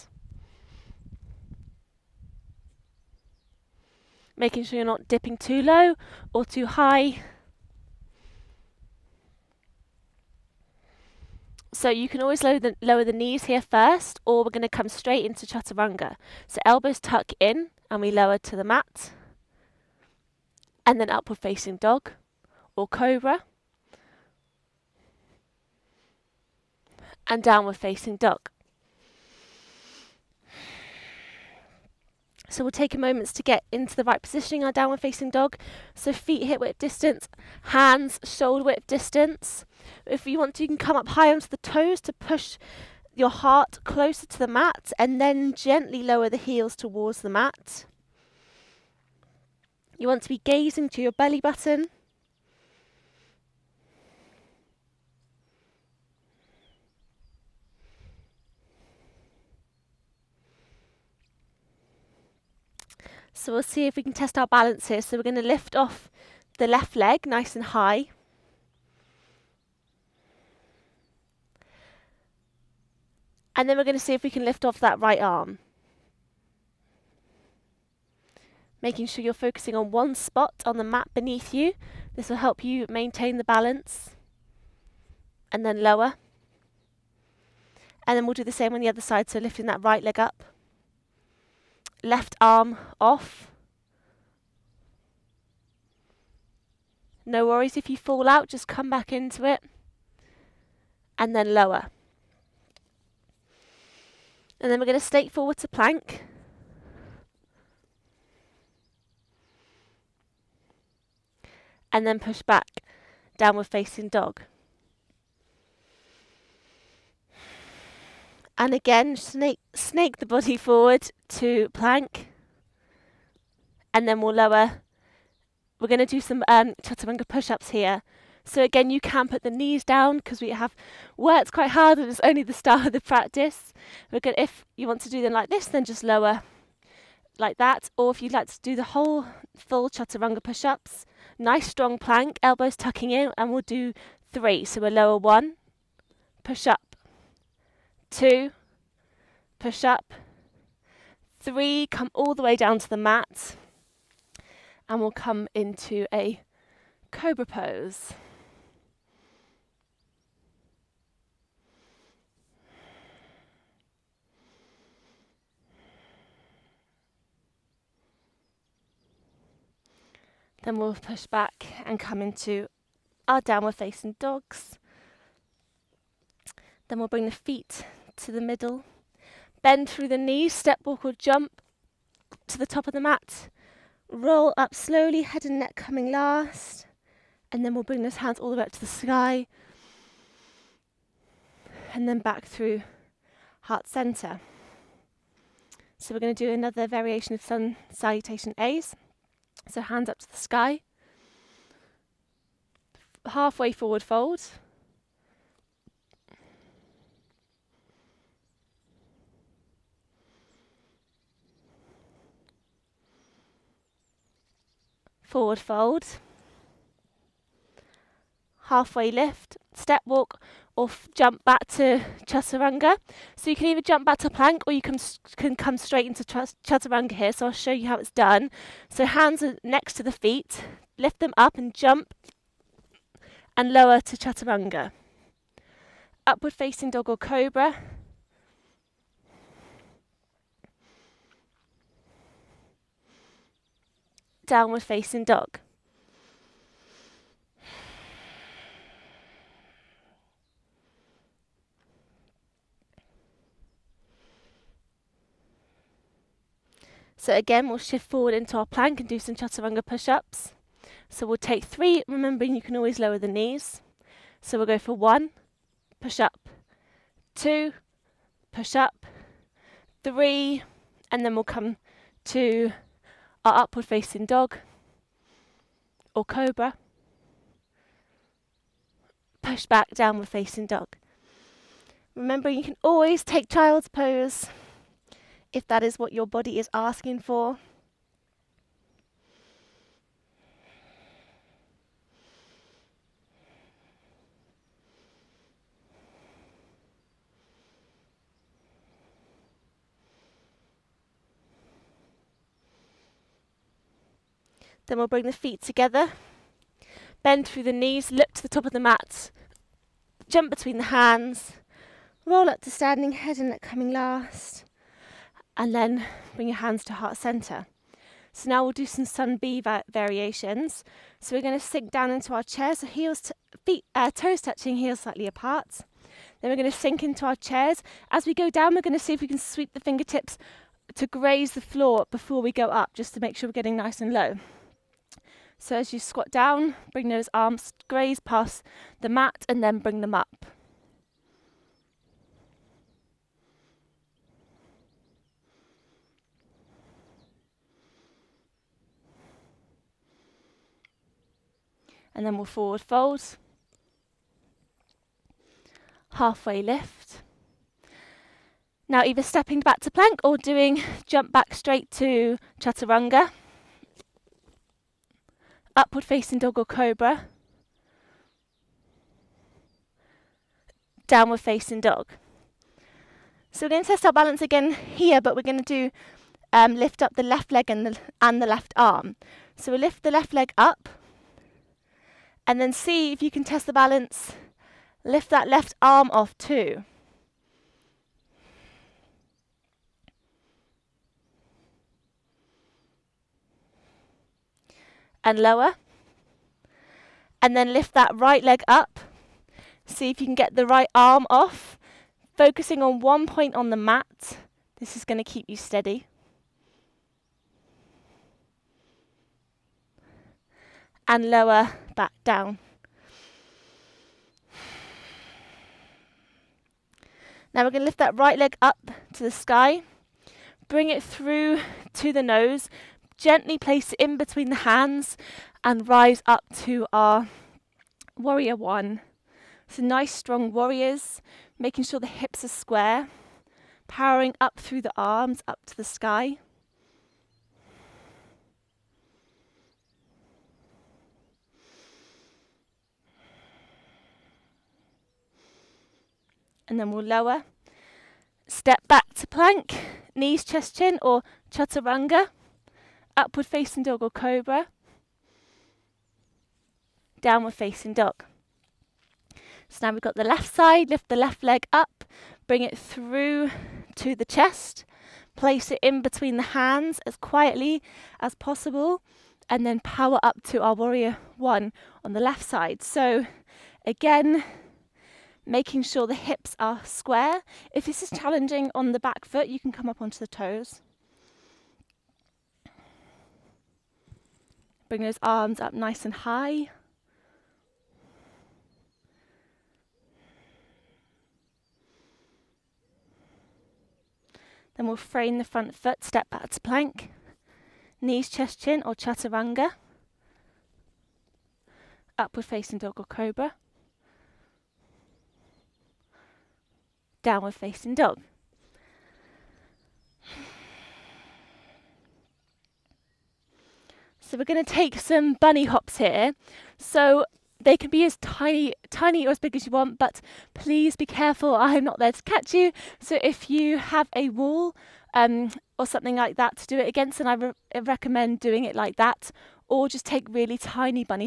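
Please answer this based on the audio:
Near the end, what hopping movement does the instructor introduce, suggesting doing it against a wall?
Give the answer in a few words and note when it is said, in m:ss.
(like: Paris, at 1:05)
bunny hops, at 8:35.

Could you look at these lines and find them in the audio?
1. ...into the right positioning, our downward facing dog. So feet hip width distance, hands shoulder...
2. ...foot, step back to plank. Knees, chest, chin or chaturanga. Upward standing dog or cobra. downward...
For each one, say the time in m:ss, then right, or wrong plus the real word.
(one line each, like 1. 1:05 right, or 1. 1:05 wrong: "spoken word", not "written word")
1. 0:33 right
2. 8:15 wrong: "facing", not "standing".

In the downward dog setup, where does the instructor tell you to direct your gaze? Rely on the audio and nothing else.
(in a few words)
belly button.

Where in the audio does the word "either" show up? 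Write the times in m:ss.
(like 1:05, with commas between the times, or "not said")
3:43, 5:59.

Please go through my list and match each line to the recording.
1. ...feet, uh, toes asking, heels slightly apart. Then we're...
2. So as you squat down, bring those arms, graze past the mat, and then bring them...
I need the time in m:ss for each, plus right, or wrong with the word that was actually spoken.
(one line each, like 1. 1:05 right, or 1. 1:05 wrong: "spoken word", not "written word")
1. 5:23 wrong: "touching", not "asking"
2. 5:35 right.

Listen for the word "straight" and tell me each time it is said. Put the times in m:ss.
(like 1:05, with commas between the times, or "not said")
0:14, 3:45, 6:01.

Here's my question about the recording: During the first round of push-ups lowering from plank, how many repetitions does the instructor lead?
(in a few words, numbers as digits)
3.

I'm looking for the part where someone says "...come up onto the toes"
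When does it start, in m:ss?
7:59.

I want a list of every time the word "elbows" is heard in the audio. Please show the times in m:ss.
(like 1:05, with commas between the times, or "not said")
0:16, 2:22.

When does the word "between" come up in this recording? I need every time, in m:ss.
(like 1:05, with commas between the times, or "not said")
5:10, 7:04, 7:46.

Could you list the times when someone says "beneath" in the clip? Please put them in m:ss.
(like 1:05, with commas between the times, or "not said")
1:21.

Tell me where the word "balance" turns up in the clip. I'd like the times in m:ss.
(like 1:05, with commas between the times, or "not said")
1:04, 1:23, 6:14, 6:23.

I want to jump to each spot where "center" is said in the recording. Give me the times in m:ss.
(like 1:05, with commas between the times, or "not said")
3:13, 5:17.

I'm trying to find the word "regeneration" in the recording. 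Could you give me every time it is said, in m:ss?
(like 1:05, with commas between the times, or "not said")
not said.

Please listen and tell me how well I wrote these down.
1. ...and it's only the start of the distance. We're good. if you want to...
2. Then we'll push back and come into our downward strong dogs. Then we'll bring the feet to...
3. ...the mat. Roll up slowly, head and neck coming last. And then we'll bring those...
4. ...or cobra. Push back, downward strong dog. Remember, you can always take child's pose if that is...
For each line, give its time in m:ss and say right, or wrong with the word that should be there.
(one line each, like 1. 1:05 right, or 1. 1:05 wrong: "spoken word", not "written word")
1. 2:11 wrong: "practice", not "distance"
2. 2:50 wrong: "facing", not "strong"
3. 3:02 right
4. 4:36 wrong: "facing", not "strong".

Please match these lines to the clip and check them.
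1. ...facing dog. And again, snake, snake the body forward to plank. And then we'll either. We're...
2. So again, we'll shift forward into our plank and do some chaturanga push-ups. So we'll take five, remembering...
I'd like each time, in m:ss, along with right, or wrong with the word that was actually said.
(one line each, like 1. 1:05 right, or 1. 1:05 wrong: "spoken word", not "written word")
1. 1:53 wrong: "lower", not "either"
2. 4:17 wrong: "three", not "five".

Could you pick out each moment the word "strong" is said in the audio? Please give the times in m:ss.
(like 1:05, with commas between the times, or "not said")
2:21, 7:10.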